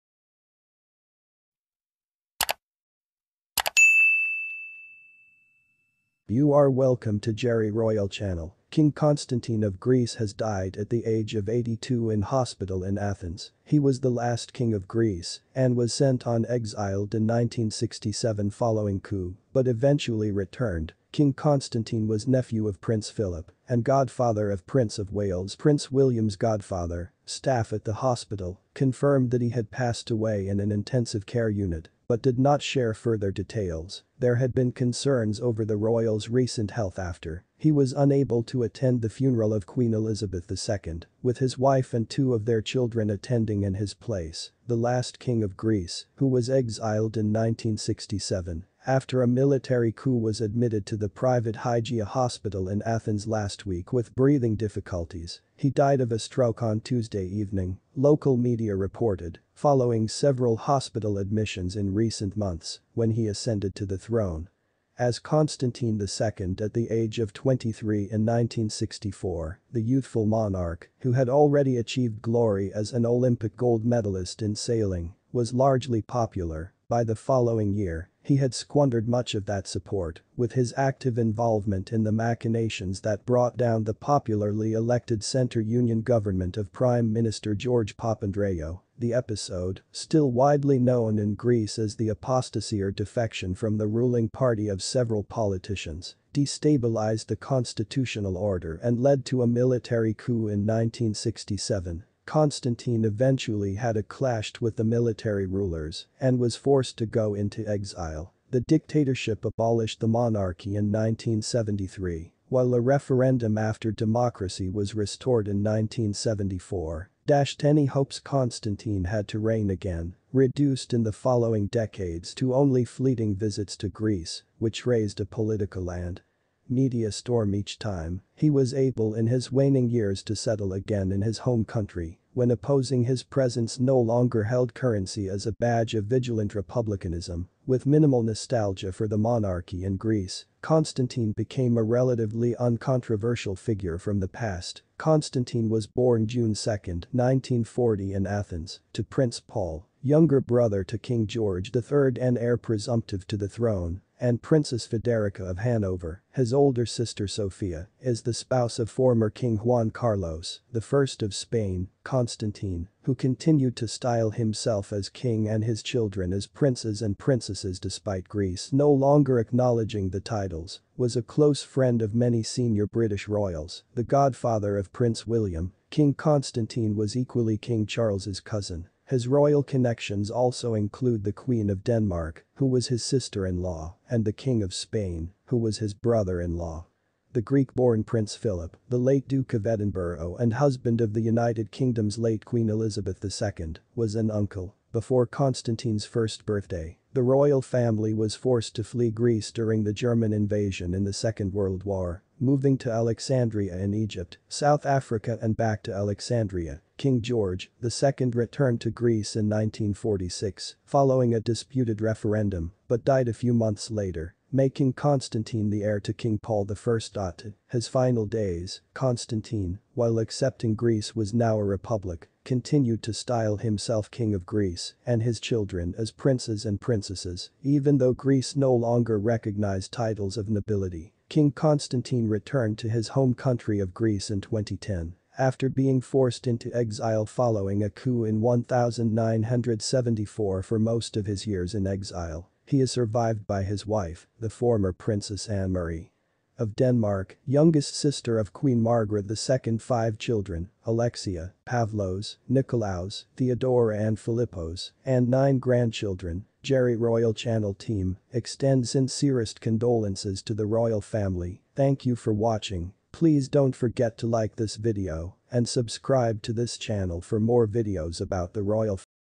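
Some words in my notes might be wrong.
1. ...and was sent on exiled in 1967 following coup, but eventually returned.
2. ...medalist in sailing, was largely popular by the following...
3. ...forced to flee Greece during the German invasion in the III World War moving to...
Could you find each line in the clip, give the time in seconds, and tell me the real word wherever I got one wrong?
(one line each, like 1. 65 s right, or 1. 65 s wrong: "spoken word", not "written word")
1. 15 s right
2. 73 s right
3. 198 s wrong: "Second", not "III".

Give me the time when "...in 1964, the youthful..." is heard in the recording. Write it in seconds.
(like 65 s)
67 s.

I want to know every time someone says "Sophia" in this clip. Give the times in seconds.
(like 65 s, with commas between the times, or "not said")
157 s.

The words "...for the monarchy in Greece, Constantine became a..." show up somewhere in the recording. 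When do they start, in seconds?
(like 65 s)
138 s.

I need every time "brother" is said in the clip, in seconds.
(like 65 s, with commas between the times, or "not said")
150 s, 185 s.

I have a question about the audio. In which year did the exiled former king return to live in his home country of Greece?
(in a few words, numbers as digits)
2010.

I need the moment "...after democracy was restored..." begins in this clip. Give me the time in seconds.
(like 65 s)
113 s.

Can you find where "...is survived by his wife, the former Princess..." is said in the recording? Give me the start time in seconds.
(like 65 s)
242 s.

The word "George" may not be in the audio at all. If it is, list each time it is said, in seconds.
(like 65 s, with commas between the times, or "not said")
87 s, 151 s, 207 s.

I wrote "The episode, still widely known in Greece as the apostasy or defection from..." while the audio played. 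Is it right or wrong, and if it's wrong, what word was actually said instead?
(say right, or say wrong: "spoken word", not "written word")
right.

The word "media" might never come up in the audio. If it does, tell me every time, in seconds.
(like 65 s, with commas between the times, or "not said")
58 s, 126 s.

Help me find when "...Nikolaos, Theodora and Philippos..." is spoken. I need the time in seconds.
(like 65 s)
252 s.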